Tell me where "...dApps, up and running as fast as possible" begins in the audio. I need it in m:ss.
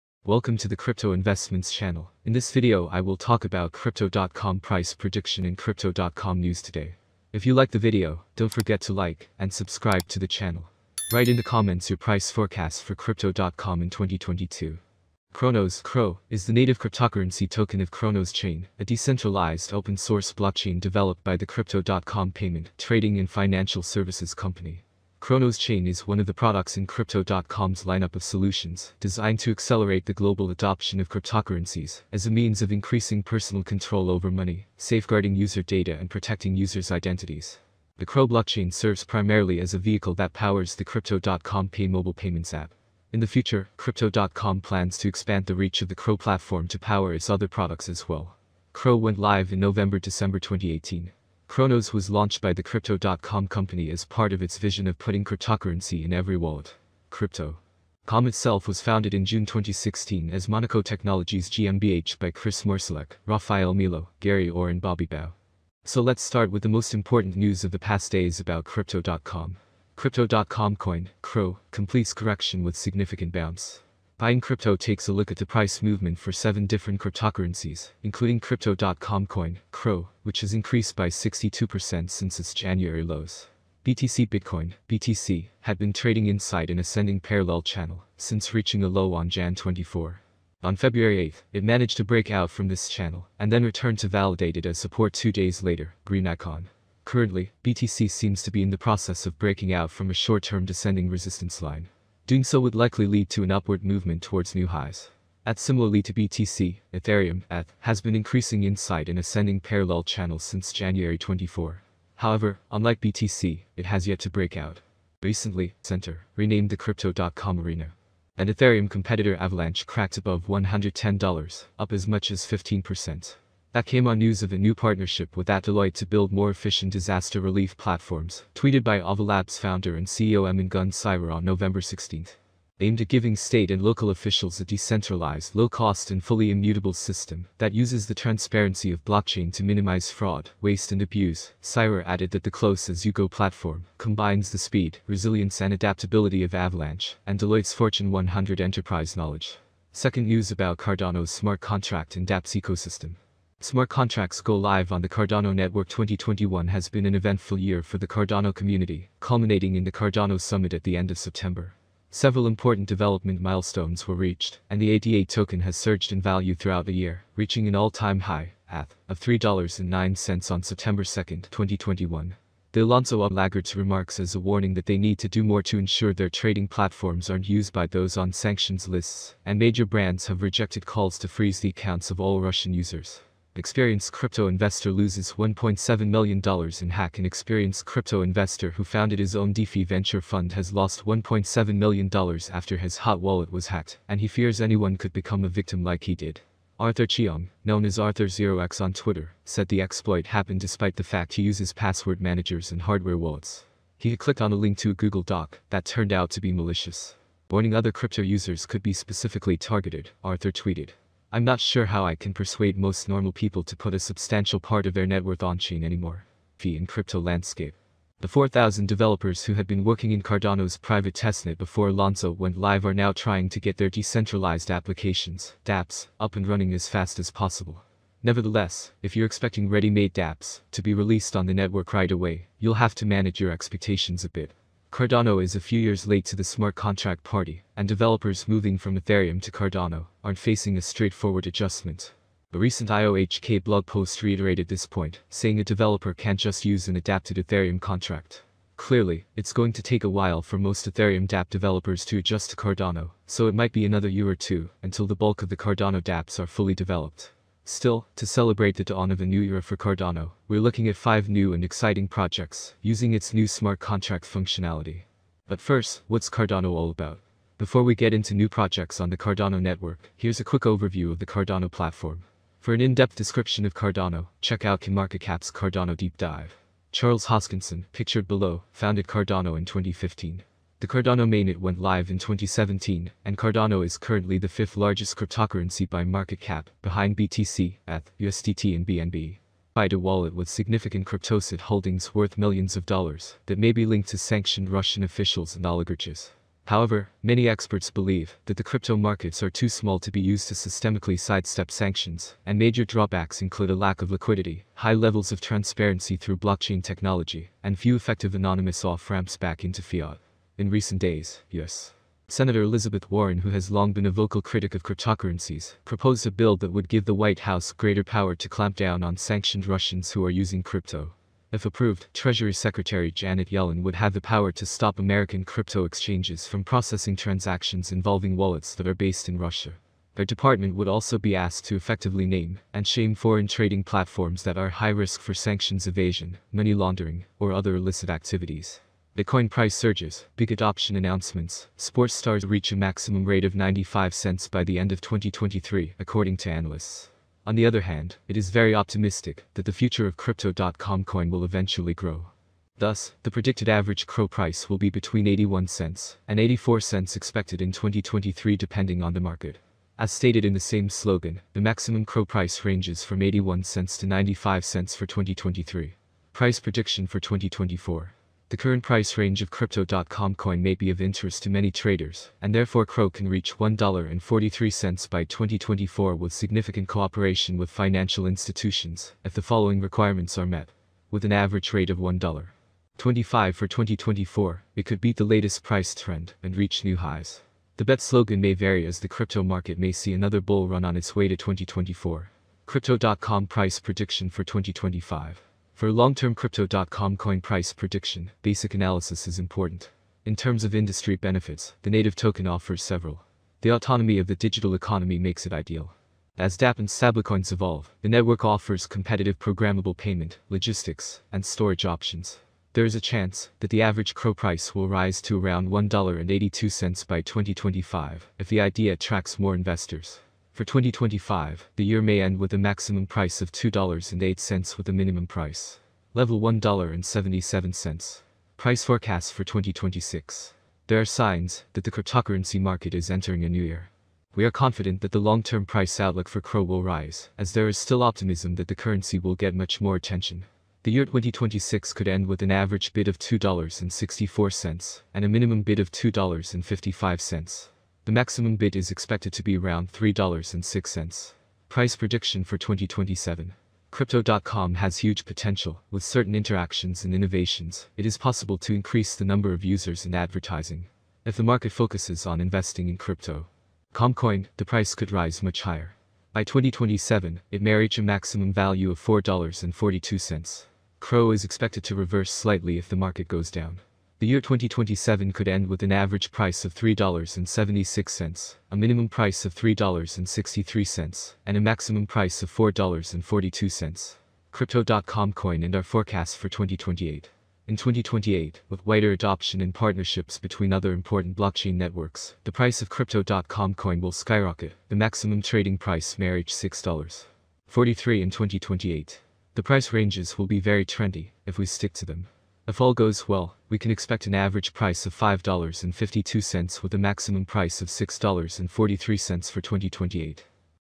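3:45.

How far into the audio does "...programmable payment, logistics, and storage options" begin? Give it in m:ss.
6:49.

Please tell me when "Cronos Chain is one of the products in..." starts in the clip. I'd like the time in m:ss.
0:25.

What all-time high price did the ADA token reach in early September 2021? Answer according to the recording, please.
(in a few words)
$3.09.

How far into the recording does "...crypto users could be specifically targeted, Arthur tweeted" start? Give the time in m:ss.
3:27.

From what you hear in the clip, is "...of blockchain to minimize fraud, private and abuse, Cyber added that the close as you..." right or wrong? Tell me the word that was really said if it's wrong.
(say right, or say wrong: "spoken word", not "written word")
wrong: "waste", not "private".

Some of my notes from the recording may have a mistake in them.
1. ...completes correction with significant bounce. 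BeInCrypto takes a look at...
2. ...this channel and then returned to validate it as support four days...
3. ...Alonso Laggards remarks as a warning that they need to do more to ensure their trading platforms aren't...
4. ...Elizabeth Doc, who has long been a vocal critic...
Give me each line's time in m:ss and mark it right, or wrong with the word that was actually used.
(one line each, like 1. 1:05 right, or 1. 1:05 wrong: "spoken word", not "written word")
1. 1:11 right
2. 1:32 wrong: "two", not "four"
3. 2:52 right
4. 5:12 wrong: "Warren", not "Doc".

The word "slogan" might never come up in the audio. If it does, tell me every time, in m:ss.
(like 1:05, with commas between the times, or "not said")
6:00, 6:28.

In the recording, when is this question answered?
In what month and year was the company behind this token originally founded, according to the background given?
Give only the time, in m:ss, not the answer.
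0:59.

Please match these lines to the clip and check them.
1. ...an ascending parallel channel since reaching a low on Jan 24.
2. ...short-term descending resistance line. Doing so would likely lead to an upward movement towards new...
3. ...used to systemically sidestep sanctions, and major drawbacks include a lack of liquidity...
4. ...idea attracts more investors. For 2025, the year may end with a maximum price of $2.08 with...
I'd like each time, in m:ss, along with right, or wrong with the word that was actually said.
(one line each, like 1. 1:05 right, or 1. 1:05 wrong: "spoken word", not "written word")
1. 1:26 right
2. 1:40 right
3. 5:00 right
4. 6:58 right.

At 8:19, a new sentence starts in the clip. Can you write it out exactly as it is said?
The price ranges will be very trendy, if we stick to them.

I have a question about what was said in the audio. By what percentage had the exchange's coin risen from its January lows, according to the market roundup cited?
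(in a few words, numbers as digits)
62%.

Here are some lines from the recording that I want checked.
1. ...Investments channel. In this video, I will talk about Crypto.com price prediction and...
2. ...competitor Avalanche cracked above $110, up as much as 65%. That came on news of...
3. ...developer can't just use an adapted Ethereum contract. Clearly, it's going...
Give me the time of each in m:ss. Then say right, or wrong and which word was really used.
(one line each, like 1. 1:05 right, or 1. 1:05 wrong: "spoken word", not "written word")
1. 0:01 right
2. 1:58 wrong: "15", not "65"
3. 4:05 right.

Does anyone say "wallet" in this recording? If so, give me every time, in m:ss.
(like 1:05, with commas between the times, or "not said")
0:56, 3:13, 3:23, 4:49, 5:28.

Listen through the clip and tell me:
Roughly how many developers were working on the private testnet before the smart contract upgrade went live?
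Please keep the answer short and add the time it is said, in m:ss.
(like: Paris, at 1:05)
4,000, at 3:38.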